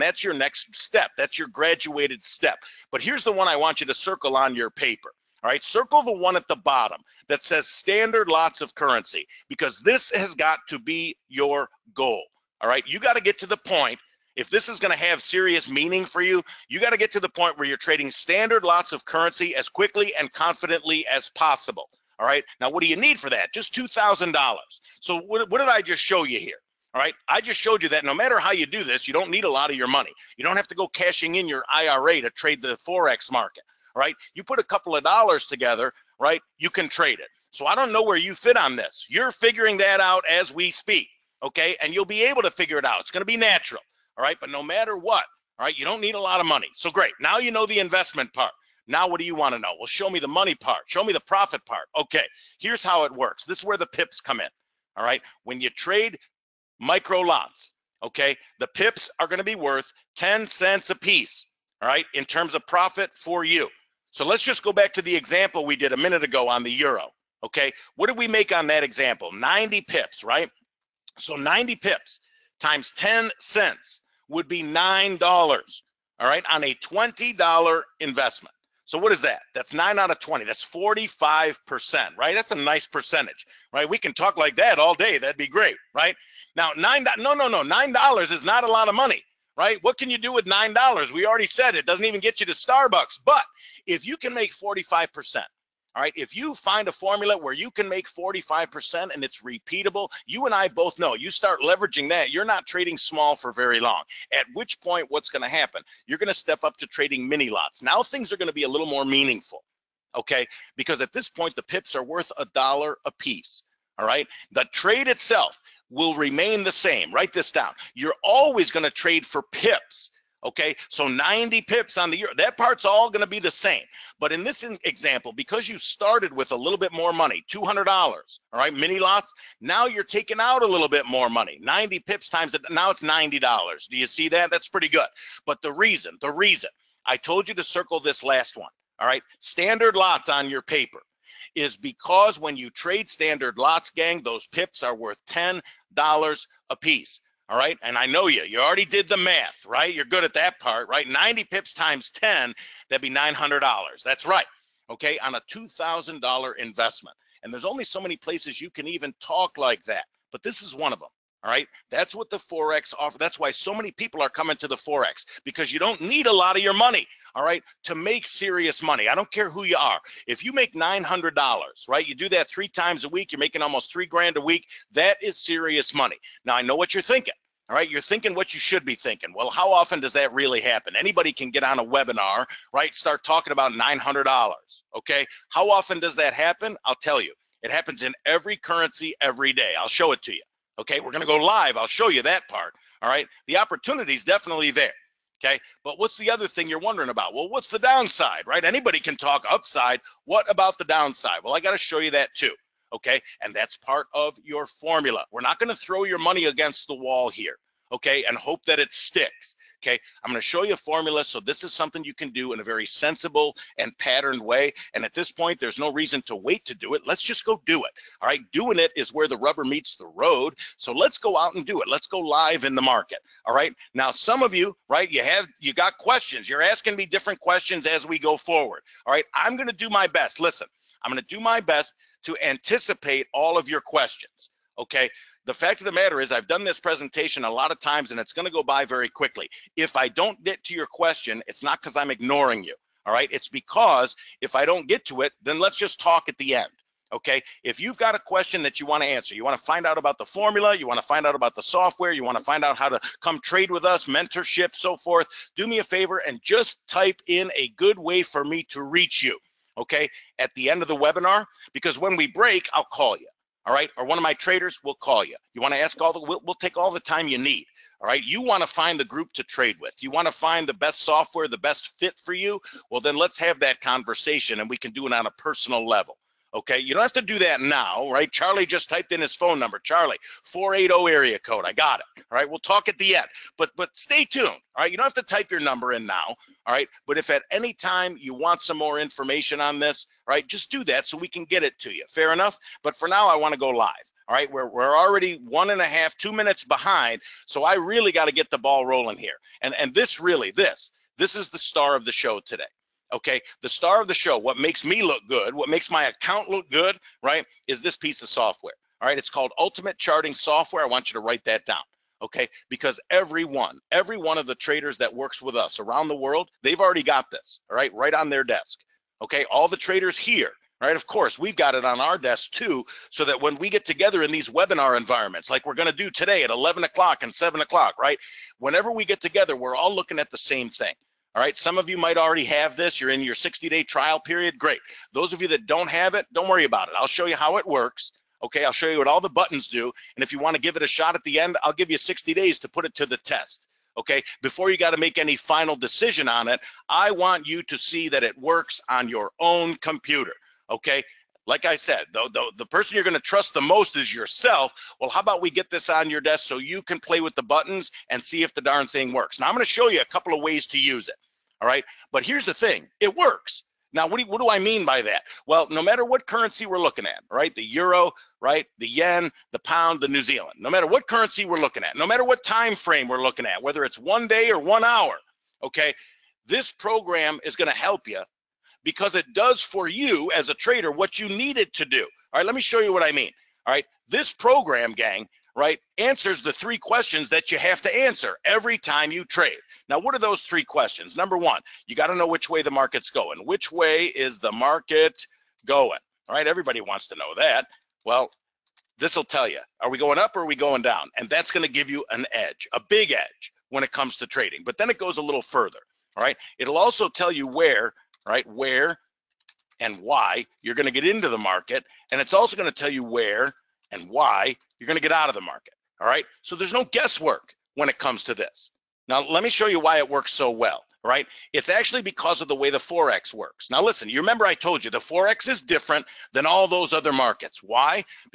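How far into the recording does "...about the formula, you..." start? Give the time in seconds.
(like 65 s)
249 s.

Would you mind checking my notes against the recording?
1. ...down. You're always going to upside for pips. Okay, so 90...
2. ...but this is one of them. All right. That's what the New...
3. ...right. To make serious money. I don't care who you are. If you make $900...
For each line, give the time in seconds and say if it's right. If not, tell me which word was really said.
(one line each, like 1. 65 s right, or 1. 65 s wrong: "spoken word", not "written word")
1. 117 s wrong: "trade", not "upside"
2. 160 s wrong: "Forex", not "New"
3. 167 s right.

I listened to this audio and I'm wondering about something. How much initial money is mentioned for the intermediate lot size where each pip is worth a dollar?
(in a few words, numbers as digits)
$200.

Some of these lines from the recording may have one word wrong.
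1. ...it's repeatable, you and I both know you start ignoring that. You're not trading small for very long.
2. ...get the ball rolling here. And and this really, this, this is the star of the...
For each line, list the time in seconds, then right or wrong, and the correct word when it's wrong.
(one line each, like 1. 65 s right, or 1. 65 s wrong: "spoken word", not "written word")
1. 99 s wrong: "leveraging", not "ignoring"
2. 298 s right.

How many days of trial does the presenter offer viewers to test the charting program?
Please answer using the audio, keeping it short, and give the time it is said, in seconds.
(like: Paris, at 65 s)
60 days, at 341 s.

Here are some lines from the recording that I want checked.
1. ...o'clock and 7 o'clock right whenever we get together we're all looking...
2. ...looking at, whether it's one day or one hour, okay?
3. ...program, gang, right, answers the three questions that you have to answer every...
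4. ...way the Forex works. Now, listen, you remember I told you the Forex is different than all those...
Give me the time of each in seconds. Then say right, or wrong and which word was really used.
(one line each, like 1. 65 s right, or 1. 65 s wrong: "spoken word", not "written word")
1. 326 s right
2. 373 s right
3. 384 s right
4. 422 s right.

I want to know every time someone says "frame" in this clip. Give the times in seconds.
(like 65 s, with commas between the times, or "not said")
372 s.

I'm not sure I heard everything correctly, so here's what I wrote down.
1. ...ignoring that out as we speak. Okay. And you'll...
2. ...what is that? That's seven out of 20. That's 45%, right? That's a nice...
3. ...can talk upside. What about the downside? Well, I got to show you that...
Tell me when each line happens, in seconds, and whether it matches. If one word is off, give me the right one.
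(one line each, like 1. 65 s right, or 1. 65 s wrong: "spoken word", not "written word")
1. 39 s wrong: "figuring", not "ignoring"
2. 78 s wrong: "nine", not "seven"
3. 198 s right.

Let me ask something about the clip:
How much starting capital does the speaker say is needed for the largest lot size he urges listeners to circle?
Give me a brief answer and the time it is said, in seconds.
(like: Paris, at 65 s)
$2,000, at 23 s.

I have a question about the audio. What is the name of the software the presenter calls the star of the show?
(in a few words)
Ultimate Charting Software.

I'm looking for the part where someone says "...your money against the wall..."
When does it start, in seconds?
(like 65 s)
206 s.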